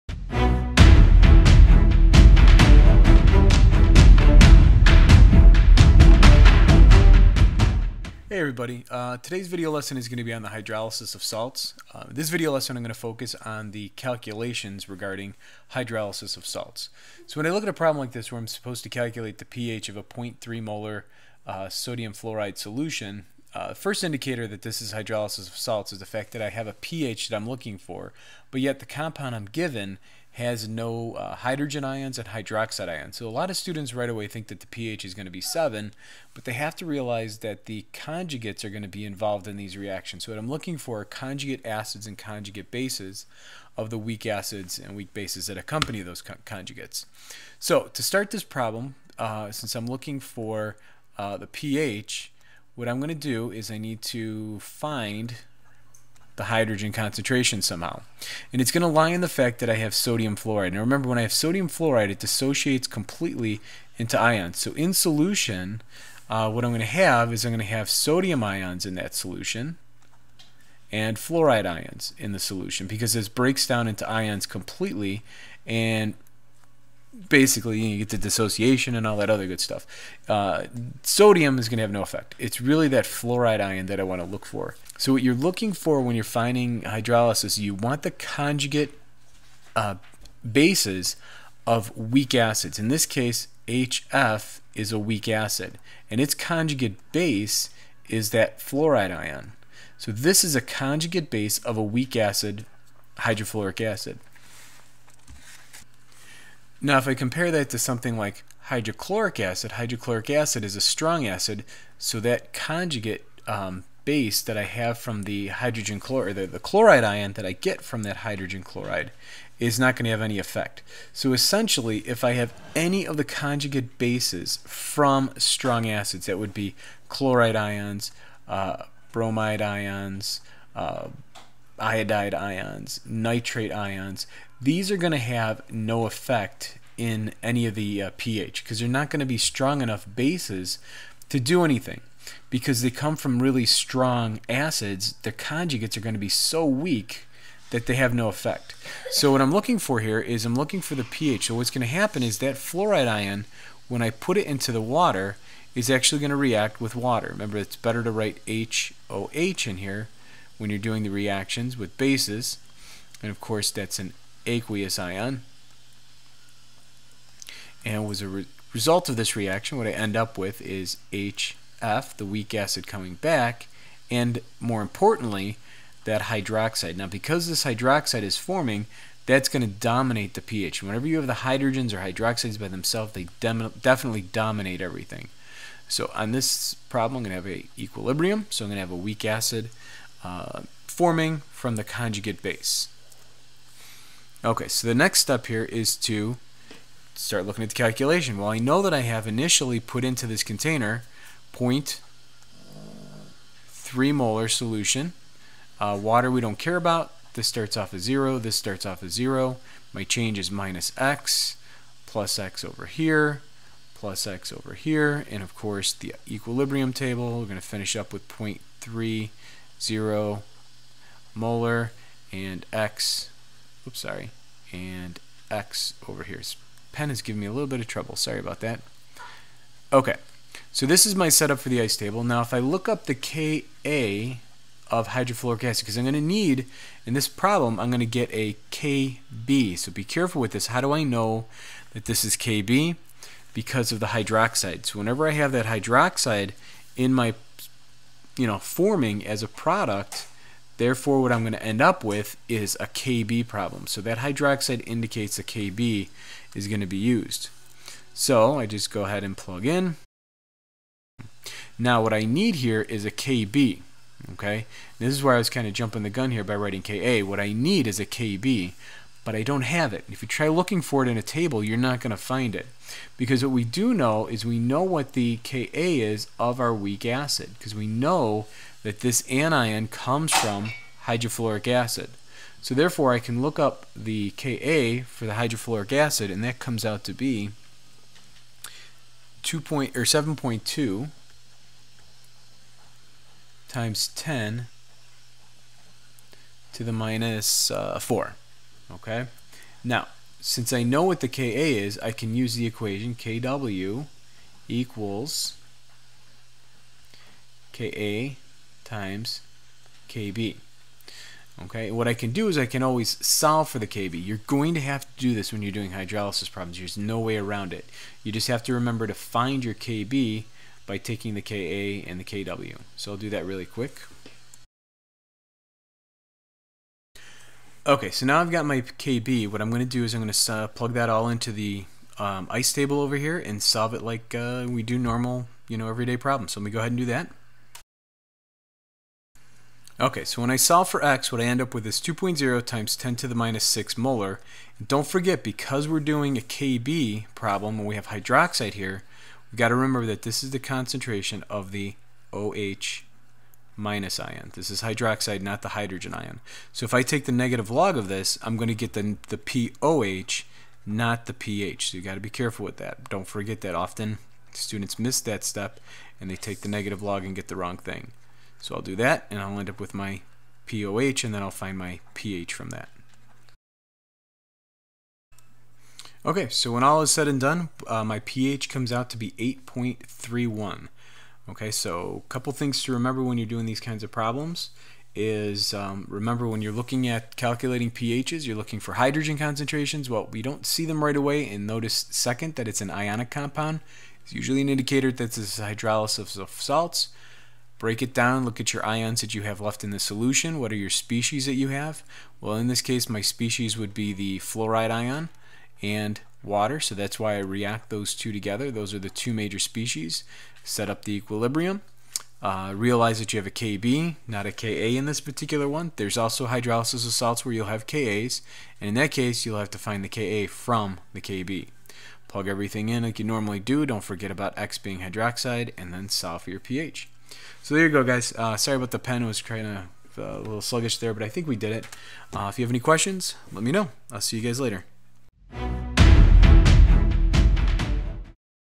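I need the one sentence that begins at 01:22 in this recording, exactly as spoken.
It's really that fluoride ion that I want to look for.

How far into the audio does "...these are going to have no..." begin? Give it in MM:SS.
02:14.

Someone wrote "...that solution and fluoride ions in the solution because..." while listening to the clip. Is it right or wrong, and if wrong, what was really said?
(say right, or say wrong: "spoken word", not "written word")
right.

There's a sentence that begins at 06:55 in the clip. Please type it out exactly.
There's also hydrolysis of salts where you'll have Kas, and in that case, you'll have to find the Ka from the KB.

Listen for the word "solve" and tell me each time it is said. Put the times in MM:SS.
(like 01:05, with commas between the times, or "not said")
05:13, 05:33, 05:40, 07:06.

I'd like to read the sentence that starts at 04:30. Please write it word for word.
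If you try looking for it in a table, you're not going to find it.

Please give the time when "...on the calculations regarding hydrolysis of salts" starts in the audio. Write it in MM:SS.
00:13.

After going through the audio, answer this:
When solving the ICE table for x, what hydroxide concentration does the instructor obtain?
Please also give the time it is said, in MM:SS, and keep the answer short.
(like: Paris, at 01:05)
2.0 x 10^-6 M, at 05:41.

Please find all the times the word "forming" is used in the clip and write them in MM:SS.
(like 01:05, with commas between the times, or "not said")
02:58, 03:10, 04:08.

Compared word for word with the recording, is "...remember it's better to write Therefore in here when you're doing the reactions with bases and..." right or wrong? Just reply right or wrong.
wrong.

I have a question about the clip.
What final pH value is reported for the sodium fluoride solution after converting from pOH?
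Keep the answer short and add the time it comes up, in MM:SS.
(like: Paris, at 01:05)
8.31, at 06:19.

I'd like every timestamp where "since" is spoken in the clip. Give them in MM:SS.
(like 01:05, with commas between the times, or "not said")
00:49, 05:00.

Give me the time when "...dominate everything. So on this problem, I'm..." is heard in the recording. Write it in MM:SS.
03:04.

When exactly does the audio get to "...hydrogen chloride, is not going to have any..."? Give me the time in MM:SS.
01:58.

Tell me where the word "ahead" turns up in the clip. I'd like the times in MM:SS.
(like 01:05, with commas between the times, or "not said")
04:19, 05:36.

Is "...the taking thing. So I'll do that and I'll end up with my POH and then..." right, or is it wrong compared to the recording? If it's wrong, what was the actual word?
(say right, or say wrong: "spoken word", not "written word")
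wrong: "wrong", not "taking".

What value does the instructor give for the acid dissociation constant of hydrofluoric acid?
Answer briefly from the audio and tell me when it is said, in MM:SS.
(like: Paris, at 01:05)
7.2 x 10^-4, at 04:50.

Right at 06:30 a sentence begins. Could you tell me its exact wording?
Well, we don't see them right away and notice second that it's an ionic compound.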